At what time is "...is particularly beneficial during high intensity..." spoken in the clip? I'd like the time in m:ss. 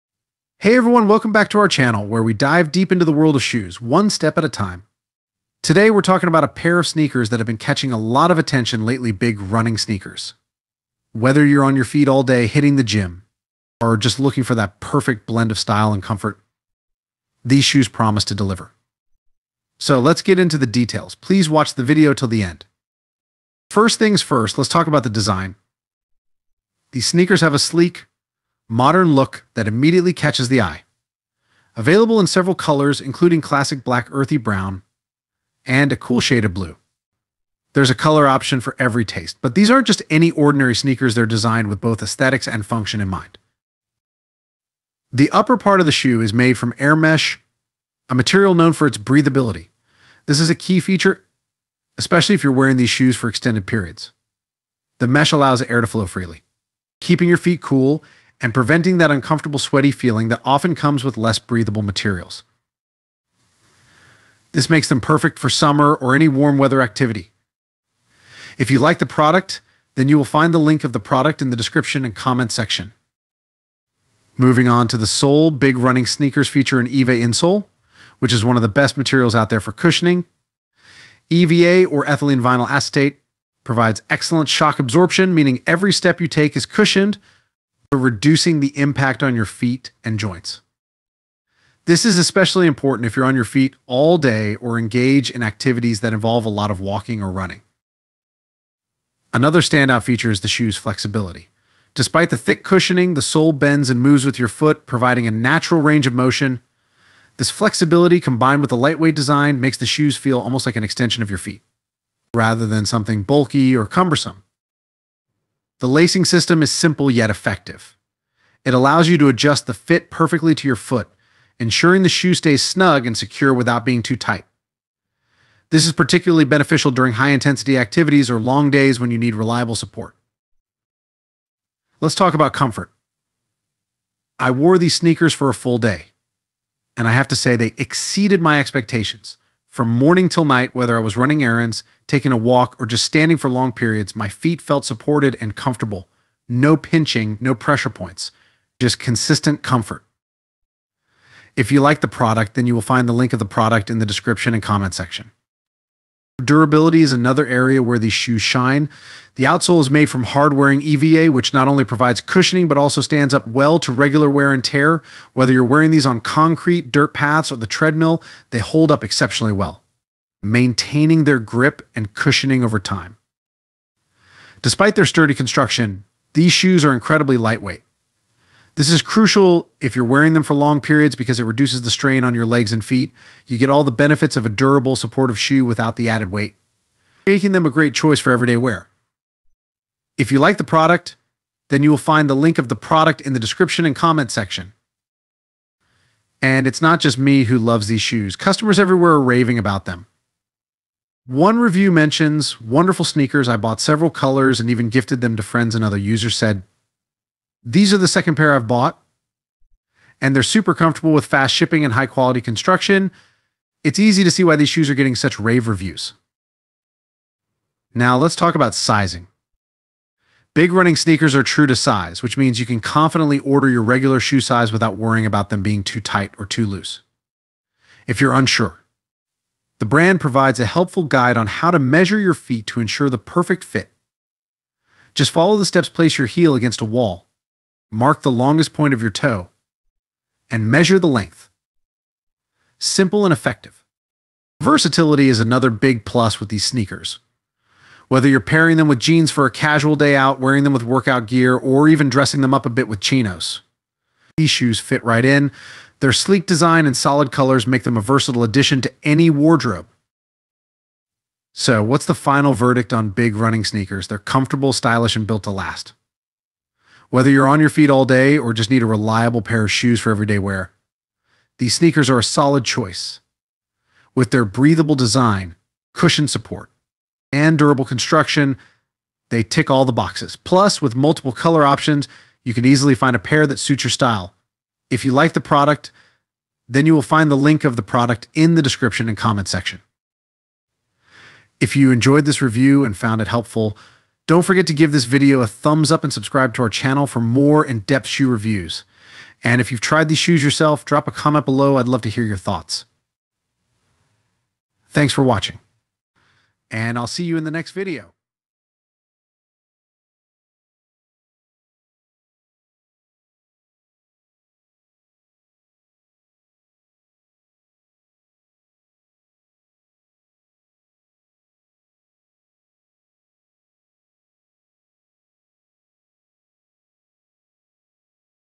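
2:05.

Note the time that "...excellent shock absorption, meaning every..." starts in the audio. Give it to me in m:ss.
1:24.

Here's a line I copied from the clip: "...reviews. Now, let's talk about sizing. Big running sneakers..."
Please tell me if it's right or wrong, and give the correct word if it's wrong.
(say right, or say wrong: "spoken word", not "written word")
right.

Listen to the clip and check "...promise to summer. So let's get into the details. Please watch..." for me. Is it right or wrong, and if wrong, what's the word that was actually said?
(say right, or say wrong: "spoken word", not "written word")
wrong: "deliver", not "summer".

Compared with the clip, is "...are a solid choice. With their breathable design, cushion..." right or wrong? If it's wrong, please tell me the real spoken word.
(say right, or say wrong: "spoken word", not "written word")
right.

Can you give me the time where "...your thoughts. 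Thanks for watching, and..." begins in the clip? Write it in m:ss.
5:02.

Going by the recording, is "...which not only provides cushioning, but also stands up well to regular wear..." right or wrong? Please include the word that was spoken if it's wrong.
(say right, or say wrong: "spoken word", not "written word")
right.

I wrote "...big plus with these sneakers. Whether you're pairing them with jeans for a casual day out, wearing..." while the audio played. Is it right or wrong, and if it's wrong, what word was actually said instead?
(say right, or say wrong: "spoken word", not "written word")
right.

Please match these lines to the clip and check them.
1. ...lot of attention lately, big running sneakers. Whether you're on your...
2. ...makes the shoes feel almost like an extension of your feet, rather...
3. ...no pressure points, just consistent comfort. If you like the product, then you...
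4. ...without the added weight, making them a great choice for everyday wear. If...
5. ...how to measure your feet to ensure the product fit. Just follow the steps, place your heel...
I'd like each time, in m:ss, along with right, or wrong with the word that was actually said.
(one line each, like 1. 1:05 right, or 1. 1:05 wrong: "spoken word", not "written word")
1. 0:07 right
2. 1:49 right
3. 2:27 right
4. 3:05 right
5. 3:51 wrong: "perfect", not "product".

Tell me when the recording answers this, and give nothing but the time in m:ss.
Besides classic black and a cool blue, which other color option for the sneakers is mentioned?
0:34.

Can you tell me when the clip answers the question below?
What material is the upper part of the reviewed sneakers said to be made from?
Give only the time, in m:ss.
0:46.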